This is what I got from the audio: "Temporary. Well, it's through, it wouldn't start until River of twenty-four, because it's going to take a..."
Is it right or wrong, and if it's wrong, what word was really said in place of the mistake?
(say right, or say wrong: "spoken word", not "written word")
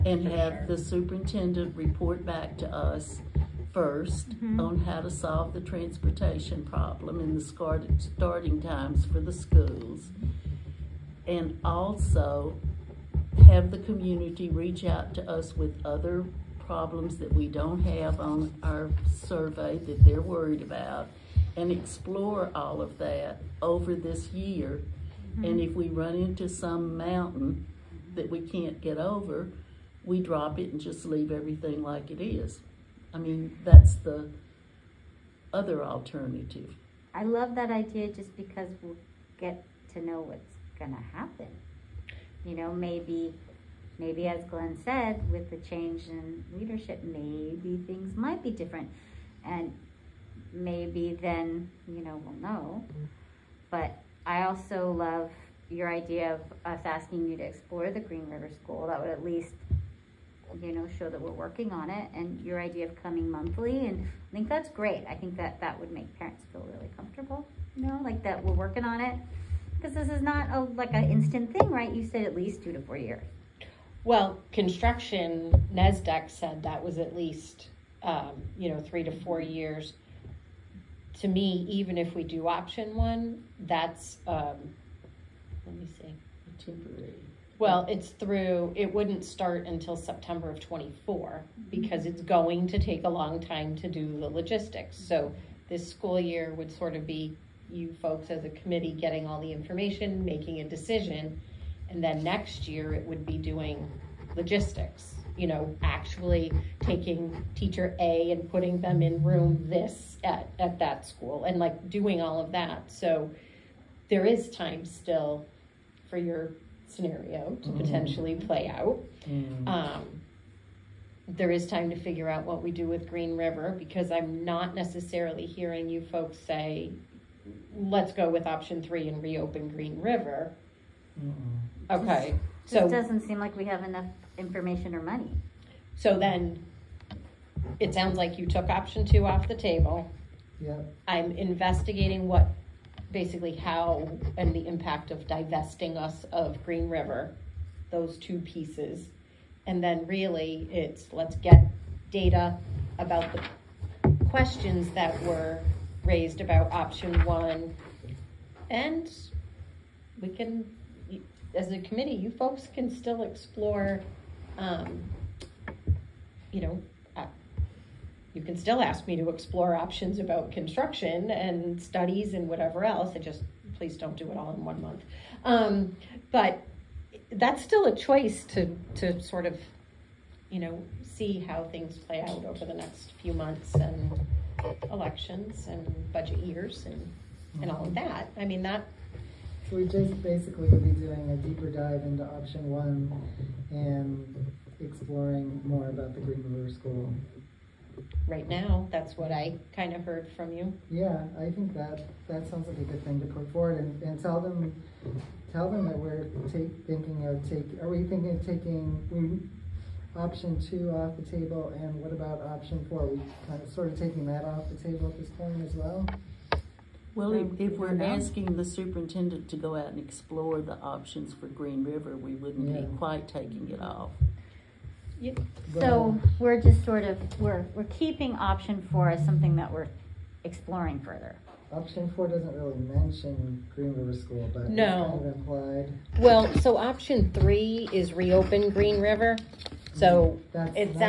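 wrong: "September", not "River".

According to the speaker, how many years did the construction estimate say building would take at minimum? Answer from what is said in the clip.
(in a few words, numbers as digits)
3 to 4 years.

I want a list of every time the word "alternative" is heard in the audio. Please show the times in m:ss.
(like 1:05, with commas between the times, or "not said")
0:35.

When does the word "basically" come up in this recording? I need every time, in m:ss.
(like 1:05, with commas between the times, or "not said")
2:23, 3:10.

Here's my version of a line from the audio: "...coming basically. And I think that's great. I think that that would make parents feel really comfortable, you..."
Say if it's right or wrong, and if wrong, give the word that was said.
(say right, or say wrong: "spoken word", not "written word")
wrong: "monthly", not "basically".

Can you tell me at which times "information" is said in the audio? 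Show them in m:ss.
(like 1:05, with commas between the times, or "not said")
1:39, 2:14.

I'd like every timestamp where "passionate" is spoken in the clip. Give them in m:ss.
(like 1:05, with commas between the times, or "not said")
not said.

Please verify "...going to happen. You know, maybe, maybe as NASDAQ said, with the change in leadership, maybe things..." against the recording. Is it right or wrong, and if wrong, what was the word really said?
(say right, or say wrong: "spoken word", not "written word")
wrong: "Glenn", not "NASDAQ".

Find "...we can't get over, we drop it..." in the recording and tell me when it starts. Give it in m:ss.
0:28.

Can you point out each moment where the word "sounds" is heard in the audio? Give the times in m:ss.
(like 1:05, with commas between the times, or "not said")
2:17, 3:22.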